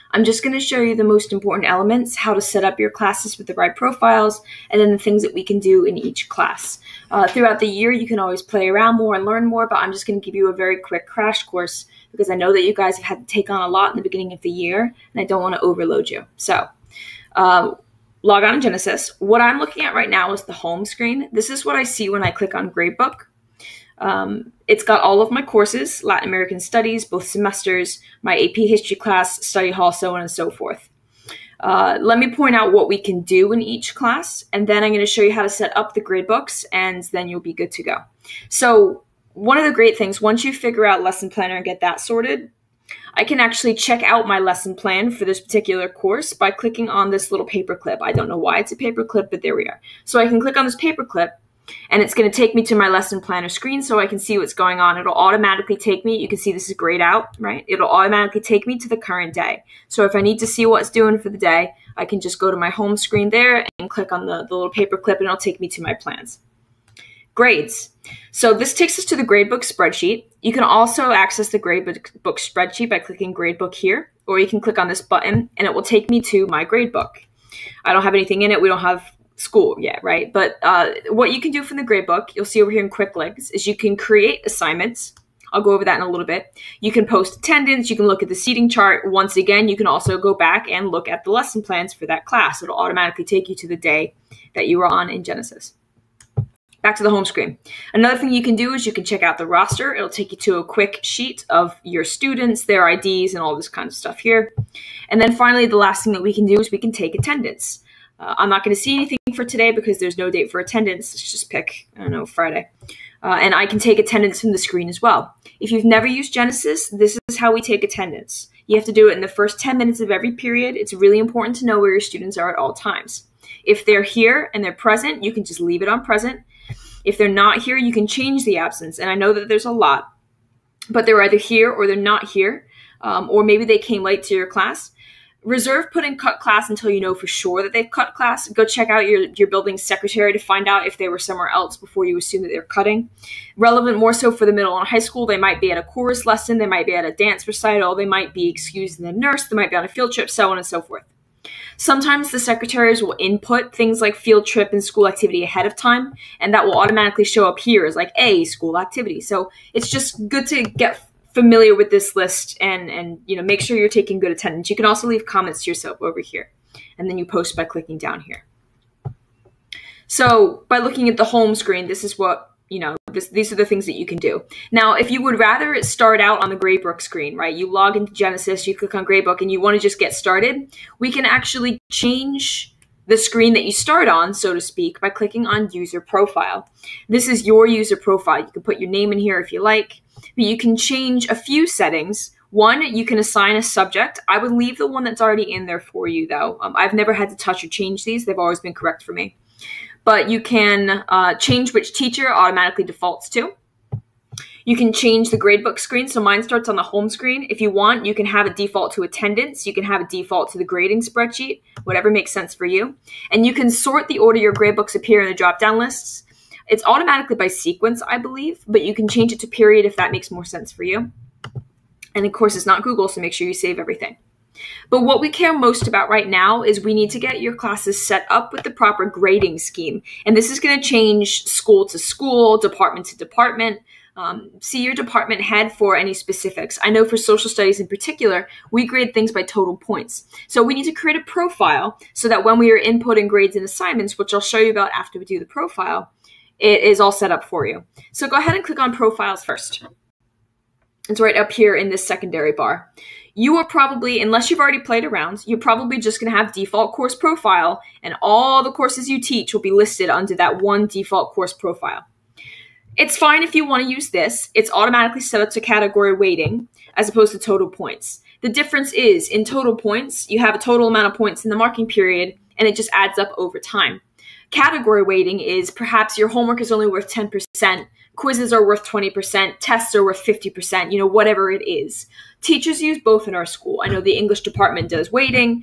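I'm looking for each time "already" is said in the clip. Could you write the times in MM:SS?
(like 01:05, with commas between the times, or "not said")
03:15, 04:14.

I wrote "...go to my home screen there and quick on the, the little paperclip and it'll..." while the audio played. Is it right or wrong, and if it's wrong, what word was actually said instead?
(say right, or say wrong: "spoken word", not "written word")
wrong: "click", not "quick".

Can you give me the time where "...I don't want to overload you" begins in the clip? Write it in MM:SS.
00:15.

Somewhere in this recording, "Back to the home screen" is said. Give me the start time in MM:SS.
01:36.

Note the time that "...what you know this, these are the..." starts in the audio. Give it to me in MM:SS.
02:52.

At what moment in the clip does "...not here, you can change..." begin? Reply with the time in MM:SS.
02:07.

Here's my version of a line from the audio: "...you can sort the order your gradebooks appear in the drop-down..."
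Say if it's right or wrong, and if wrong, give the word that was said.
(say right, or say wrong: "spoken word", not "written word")
right.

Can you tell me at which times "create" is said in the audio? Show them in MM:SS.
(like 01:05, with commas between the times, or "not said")
01:23, 04:00.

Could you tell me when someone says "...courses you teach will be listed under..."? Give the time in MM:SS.
04:18.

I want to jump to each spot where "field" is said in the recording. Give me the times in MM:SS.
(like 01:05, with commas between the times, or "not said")
02:29, 02:34.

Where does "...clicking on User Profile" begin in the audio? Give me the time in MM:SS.
03:05.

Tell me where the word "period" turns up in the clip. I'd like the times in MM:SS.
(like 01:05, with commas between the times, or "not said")
02:00, 03:39, 04:31.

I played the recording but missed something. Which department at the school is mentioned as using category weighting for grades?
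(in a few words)
English department.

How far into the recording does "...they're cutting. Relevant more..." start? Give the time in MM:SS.
02:22.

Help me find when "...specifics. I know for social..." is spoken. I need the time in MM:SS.
03:56.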